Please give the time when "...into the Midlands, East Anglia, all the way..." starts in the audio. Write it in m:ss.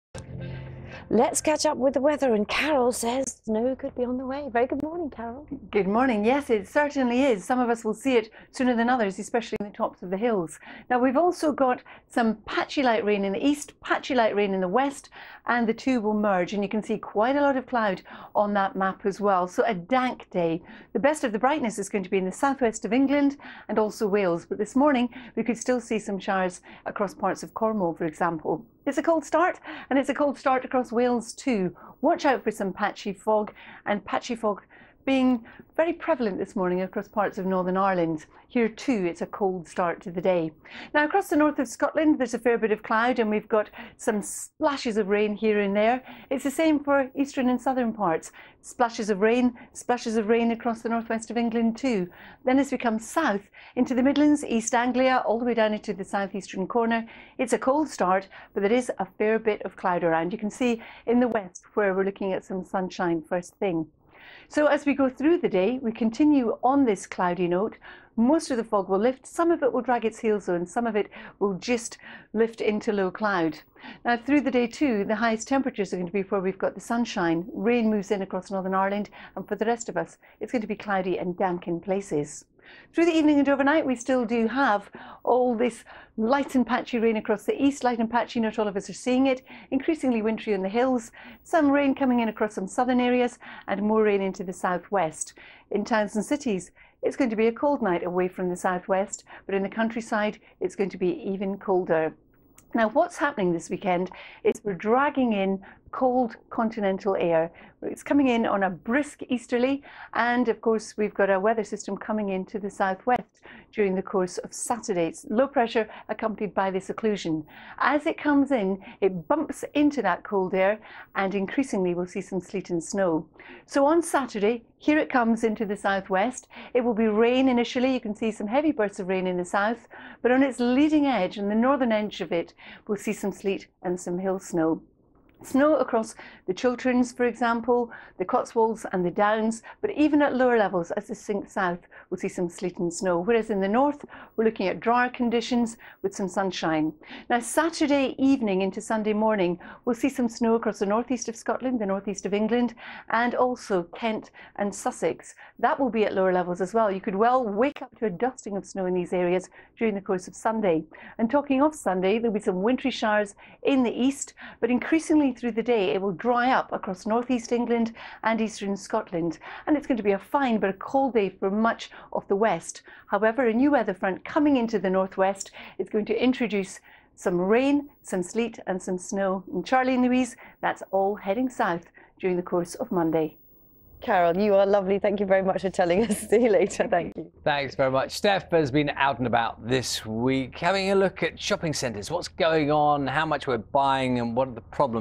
0:53.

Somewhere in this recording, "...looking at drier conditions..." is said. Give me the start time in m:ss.
2:24.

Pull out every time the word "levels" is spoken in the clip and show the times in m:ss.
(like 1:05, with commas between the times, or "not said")
2:20, 2:36.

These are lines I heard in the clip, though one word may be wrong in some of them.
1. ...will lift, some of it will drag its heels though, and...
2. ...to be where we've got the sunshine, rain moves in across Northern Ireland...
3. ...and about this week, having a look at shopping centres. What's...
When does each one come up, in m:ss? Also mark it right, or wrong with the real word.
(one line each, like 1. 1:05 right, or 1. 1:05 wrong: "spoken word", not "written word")
1. 1:08 right
2. 1:16 right
3. 3:09 right.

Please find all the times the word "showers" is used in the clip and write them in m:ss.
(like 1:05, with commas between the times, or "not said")
0:26, 2:42.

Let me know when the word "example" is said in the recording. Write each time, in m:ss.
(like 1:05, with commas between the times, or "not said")
0:28, 2:17.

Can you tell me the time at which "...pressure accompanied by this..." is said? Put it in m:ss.
1:55.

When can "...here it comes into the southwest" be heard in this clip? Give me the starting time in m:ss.
2:04.